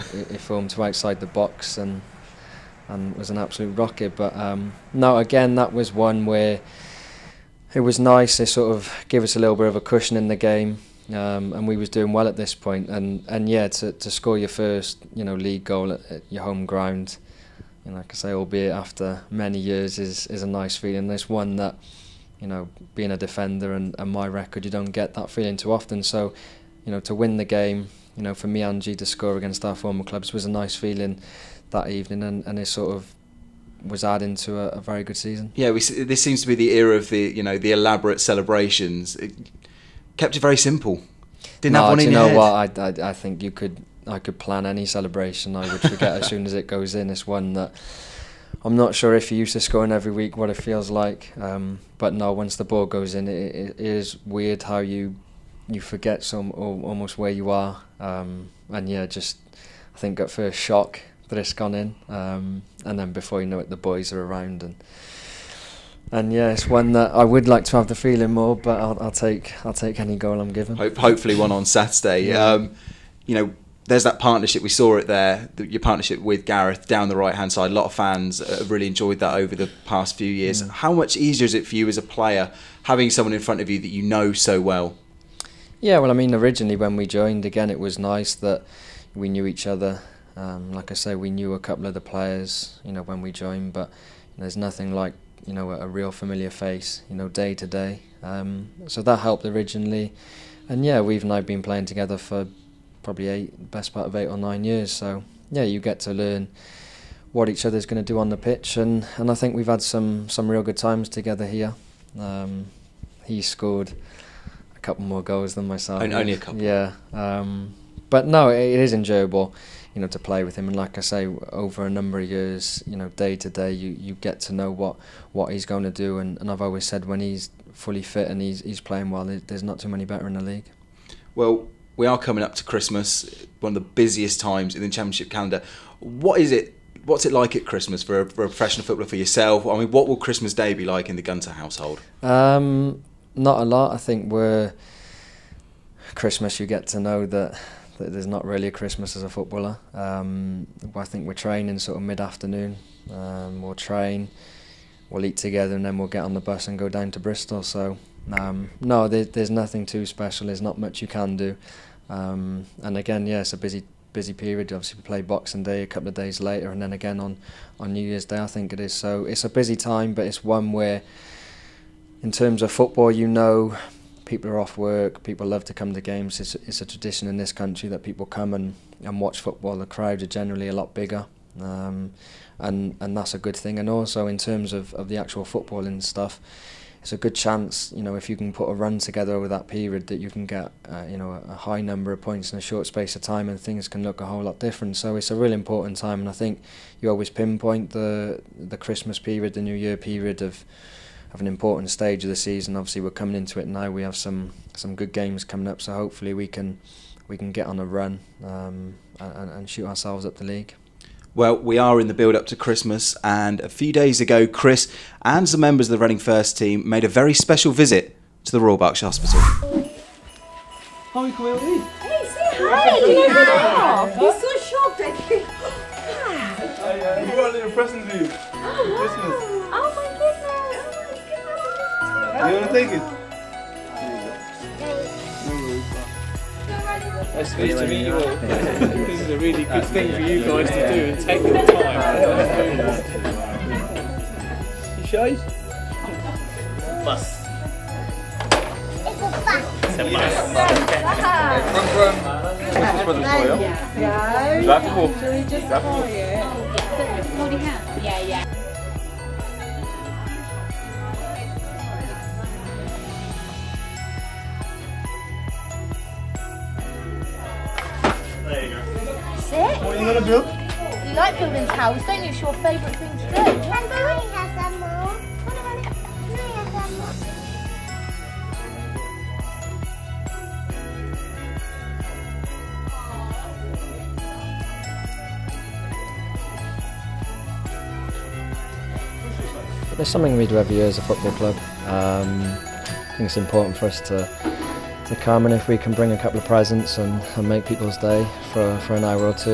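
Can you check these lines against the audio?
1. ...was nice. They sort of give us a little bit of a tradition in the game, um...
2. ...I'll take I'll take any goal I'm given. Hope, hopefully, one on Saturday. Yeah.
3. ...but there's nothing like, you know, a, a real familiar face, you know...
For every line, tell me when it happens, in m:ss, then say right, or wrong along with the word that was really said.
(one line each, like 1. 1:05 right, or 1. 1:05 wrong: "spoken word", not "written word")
1. 0:07 wrong: "cushion", not "tradition"
2. 1:09 right
3. 1:33 right.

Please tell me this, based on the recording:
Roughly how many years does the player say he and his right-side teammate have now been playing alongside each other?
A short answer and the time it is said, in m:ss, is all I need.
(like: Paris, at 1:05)
8 or 9 years, at 1:44.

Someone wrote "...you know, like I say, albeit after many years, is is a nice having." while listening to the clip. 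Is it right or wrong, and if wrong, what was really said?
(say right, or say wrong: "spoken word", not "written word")
wrong: "feeling", not "having".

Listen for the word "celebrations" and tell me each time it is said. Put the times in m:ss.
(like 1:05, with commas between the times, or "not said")
0:38, 0:44.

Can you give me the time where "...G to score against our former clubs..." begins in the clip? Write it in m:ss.
0:28.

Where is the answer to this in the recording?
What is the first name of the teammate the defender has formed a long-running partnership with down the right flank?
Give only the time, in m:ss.
1:16.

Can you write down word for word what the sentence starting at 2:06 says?
And, and I've always said when he's fully fit and he's, he's playing well, there's not too many better in the league.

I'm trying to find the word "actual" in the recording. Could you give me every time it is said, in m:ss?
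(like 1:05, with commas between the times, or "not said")
3:05.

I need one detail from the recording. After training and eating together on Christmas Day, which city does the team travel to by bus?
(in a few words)
Bristol.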